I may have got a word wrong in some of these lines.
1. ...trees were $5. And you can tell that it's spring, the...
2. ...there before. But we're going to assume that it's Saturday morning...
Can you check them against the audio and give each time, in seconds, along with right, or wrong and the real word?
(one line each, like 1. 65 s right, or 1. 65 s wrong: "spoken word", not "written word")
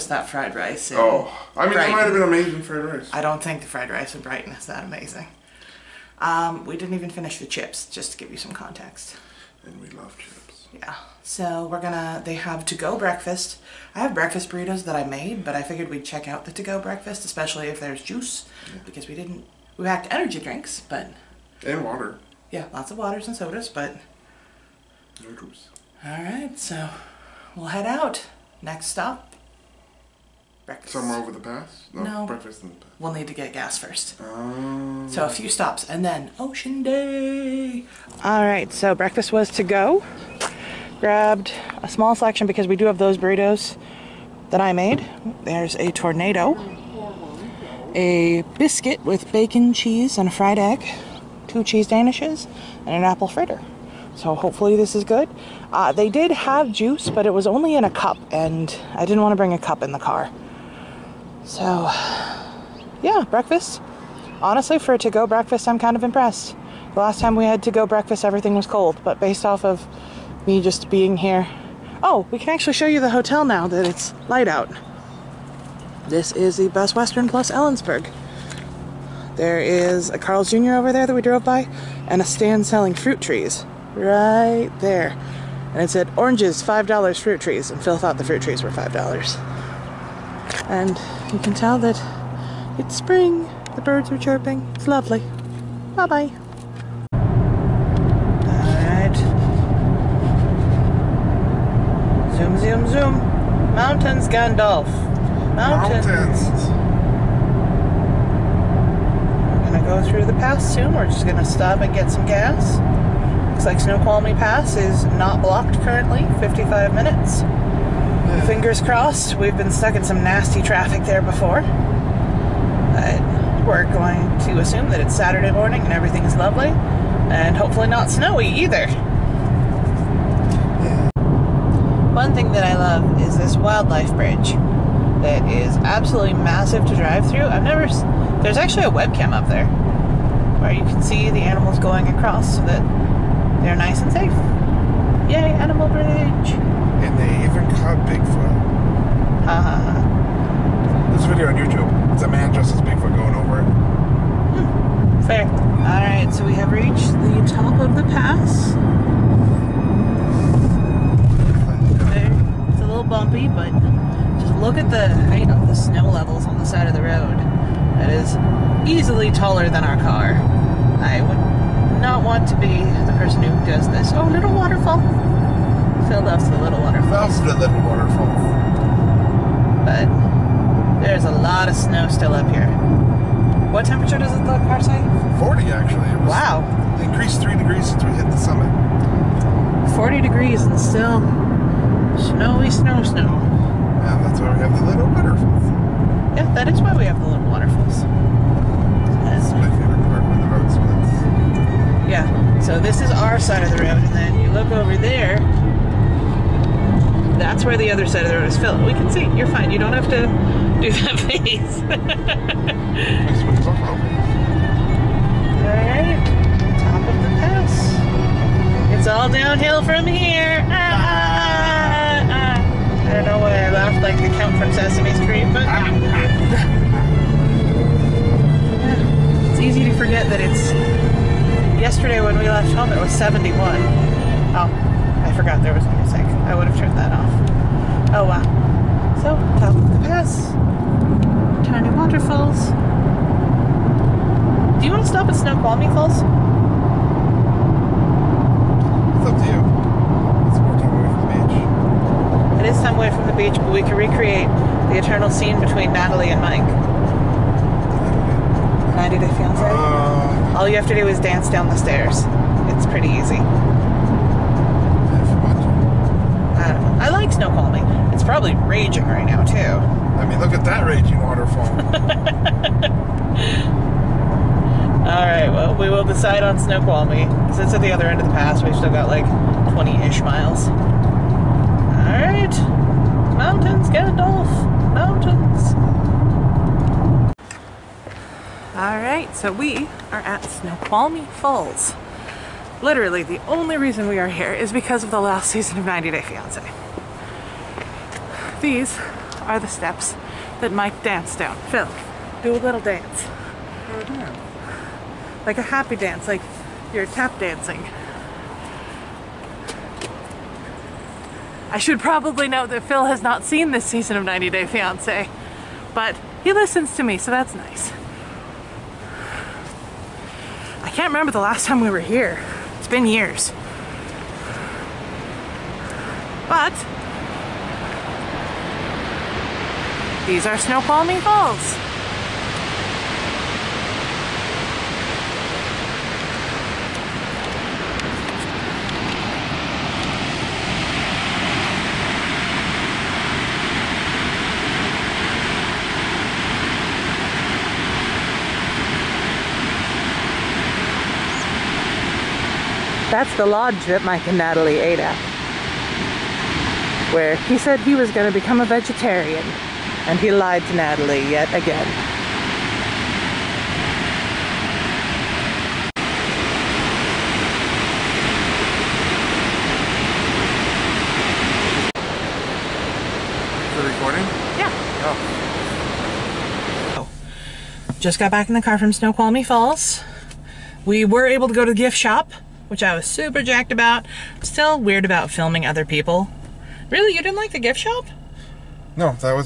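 1. 88 s right
2. 121 s right.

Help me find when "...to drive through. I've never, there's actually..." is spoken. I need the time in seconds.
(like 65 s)
136 s.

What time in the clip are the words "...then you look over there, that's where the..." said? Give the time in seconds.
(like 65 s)
204 s.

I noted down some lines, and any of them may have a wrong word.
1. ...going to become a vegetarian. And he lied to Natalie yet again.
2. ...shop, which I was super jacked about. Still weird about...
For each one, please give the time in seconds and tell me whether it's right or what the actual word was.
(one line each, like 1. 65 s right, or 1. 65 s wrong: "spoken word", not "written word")
1. 358 s right
2. 381 s right.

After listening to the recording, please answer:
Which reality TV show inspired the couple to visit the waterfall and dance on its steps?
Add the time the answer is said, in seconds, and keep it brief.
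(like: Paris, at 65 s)
90 Day Fiancé, at 259 s.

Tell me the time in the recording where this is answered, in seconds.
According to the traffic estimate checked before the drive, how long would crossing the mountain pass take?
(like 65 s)
116 s.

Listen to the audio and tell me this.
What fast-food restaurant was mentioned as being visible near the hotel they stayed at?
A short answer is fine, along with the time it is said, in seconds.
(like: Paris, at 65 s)
Carl's Jr., at 80 s.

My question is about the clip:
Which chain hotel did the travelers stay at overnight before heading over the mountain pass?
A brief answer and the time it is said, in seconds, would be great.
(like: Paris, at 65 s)
Best Western Plus Ellensburg, at 76 s.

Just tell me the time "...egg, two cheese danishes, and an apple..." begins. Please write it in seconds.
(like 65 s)
50 s.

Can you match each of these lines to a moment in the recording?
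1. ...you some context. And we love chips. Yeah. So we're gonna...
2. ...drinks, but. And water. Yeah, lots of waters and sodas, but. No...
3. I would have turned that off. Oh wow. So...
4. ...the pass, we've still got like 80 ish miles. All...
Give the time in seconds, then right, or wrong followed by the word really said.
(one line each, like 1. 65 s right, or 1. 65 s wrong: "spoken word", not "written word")
1. 8 s right
2. 20 s right
3. 236 s right
4. 278 s wrong: "20", not "80".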